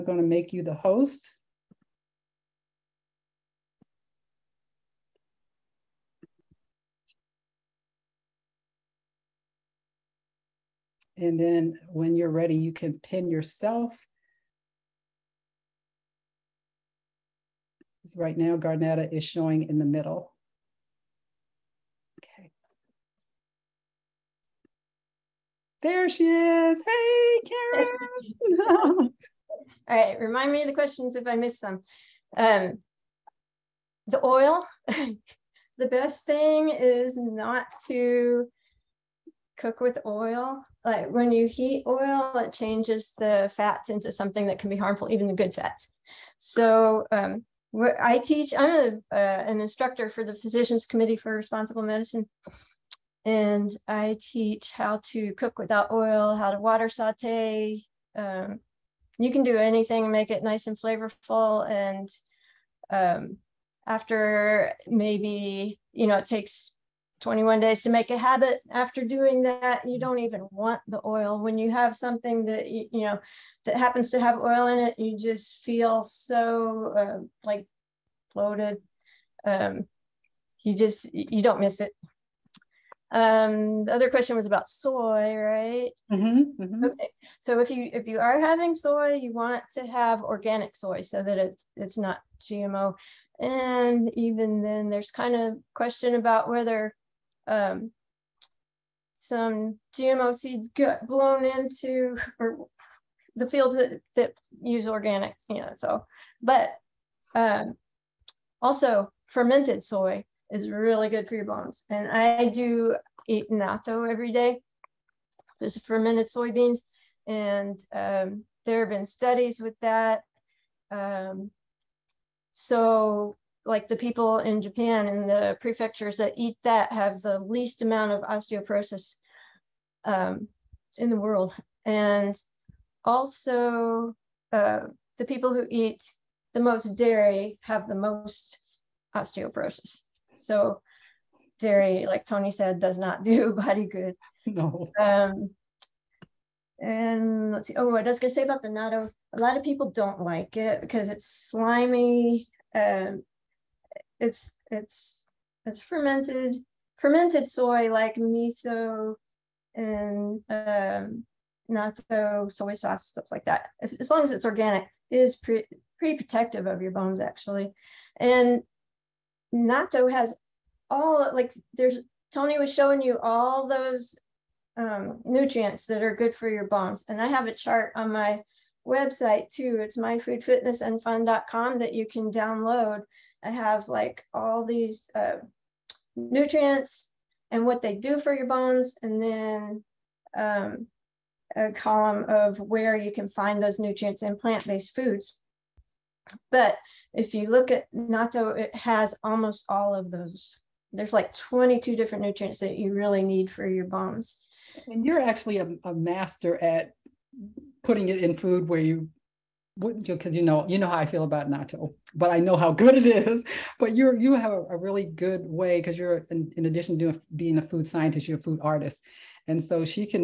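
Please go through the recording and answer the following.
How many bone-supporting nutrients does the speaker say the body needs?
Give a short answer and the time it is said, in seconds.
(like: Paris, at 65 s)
22, at 201 s.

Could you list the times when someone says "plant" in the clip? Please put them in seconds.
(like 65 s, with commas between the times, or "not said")
194 s.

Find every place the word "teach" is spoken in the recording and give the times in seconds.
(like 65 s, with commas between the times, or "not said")
48 s, 54 s.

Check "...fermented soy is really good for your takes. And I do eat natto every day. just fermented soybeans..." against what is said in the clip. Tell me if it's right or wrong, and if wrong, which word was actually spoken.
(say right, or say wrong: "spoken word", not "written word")
wrong: "bones", not "takes".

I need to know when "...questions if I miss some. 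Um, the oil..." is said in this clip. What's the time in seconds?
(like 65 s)
30 s.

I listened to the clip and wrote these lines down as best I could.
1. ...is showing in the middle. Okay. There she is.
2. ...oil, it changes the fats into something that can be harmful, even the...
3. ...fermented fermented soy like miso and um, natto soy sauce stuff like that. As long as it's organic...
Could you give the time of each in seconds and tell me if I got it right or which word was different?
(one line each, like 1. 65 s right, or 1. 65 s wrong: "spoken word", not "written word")
1. 19 s right
2. 41 s right
3. 155 s right.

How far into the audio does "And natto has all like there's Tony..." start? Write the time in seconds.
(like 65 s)
168 s.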